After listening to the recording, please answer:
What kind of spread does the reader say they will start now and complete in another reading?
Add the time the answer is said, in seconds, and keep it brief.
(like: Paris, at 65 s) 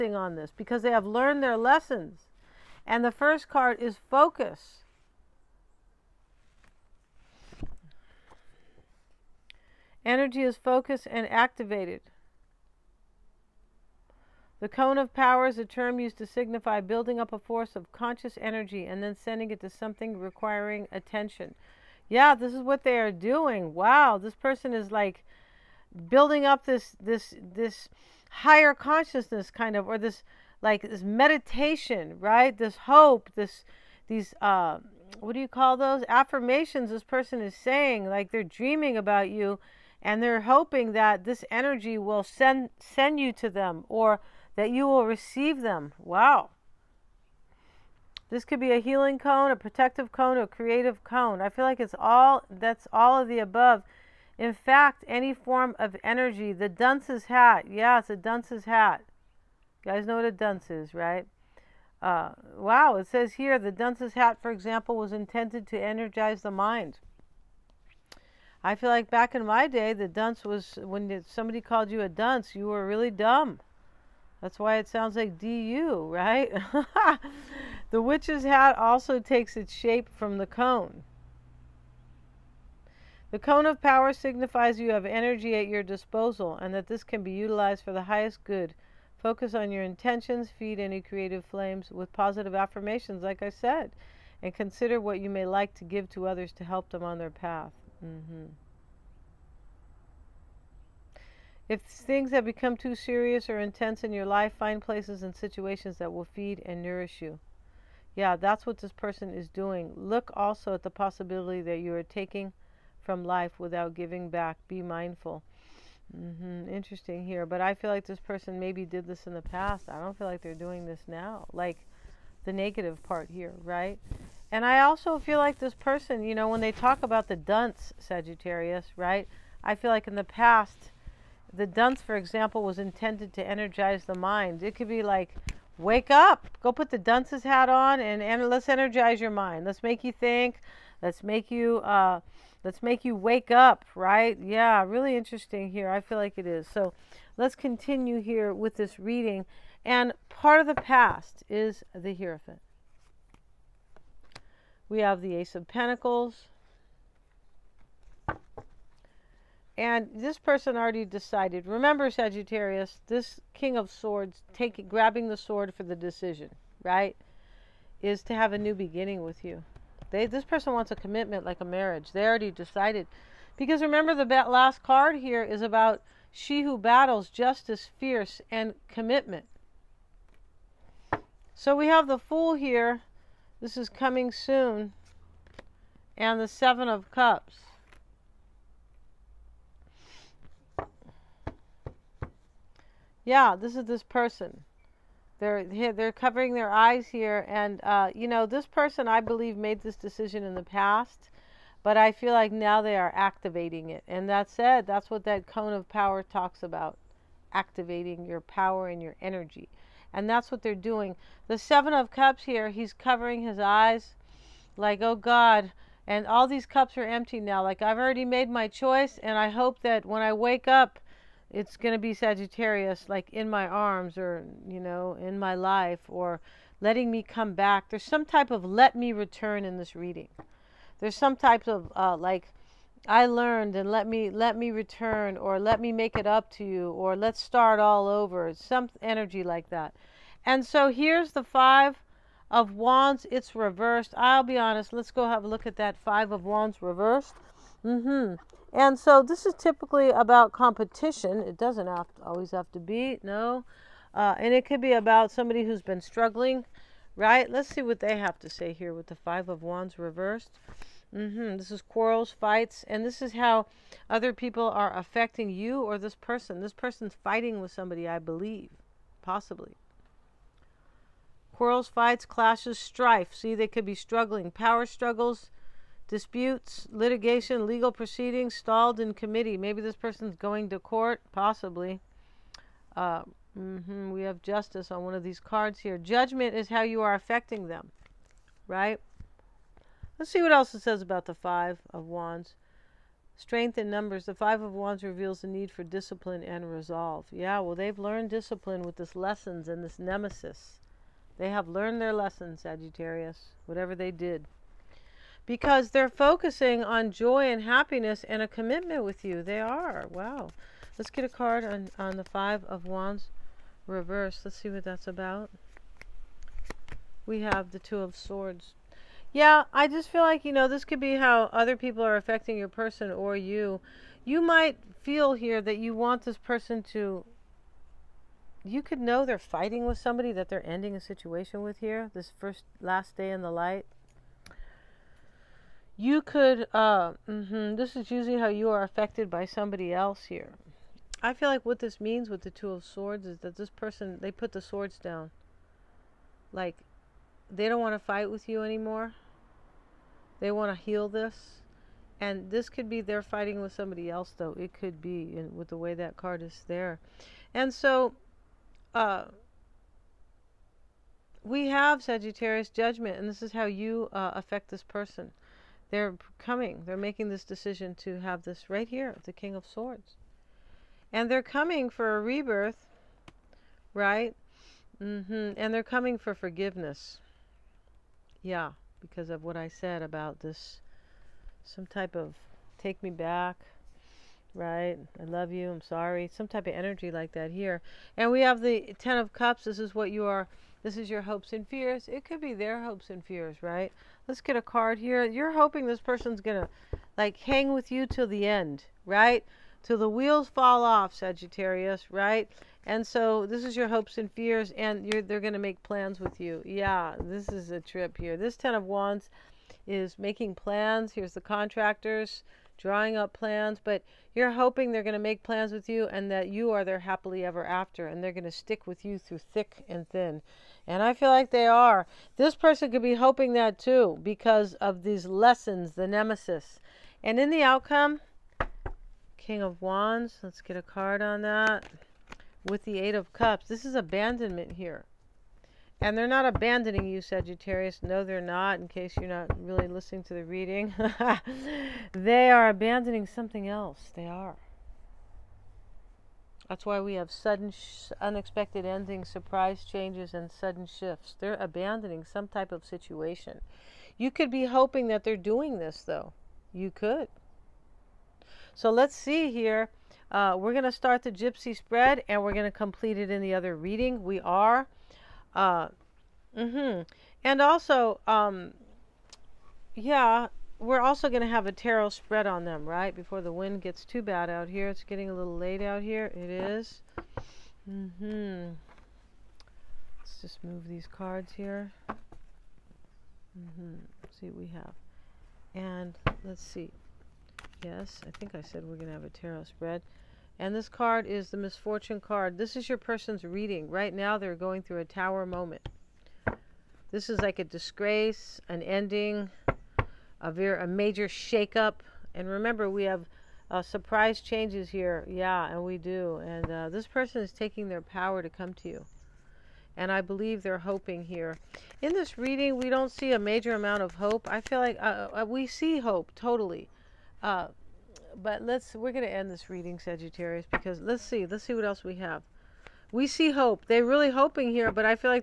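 gypsy spread, at 461 s.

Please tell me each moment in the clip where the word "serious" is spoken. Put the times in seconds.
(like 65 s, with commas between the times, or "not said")
102 s.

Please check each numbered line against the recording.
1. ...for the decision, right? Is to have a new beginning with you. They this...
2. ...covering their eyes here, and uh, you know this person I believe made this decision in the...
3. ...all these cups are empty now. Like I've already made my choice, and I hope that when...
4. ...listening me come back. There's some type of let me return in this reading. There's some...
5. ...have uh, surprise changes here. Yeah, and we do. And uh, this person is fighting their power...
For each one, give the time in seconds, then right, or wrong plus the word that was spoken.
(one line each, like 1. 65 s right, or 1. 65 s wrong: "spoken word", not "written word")
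1. 165 s right
2. 196 s right
3. 216 s right
4. 226 s wrong: "letting", not "listening"
5. 503 s wrong: "taking", not "fighting".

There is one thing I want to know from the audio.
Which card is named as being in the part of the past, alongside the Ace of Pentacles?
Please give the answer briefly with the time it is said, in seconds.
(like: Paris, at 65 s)
the Hierophant, at 151 s.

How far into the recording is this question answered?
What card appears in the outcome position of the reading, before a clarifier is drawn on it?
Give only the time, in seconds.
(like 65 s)
429 s.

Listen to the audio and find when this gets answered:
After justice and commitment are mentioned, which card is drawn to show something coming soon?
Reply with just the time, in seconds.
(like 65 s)
182 s.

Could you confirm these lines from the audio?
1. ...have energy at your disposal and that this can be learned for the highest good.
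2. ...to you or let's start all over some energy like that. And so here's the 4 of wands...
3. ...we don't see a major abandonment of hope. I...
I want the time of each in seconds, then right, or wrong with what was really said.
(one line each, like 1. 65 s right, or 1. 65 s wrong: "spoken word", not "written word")
1. 84 s wrong: "utilized", not "learned"
2. 236 s wrong: "5", not "4"
3. 512 s wrong: "amount", not "abandonment".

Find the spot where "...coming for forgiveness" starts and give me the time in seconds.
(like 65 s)
375 s.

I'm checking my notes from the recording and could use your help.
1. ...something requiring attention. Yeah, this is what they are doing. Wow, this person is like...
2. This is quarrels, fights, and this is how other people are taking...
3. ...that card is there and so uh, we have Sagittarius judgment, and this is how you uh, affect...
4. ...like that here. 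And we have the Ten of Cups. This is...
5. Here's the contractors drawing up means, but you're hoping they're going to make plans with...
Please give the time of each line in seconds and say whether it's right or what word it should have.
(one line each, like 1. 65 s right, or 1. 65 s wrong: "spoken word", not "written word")
1. 19 s right
2. 261 s wrong: "affecting", not "taking"
3. 355 s right
4. 387 s right
5. 411 s wrong: "plans", not "means".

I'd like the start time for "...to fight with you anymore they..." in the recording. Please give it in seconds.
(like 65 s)
347 s.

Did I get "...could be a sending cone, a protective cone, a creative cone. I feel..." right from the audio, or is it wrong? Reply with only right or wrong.
wrong.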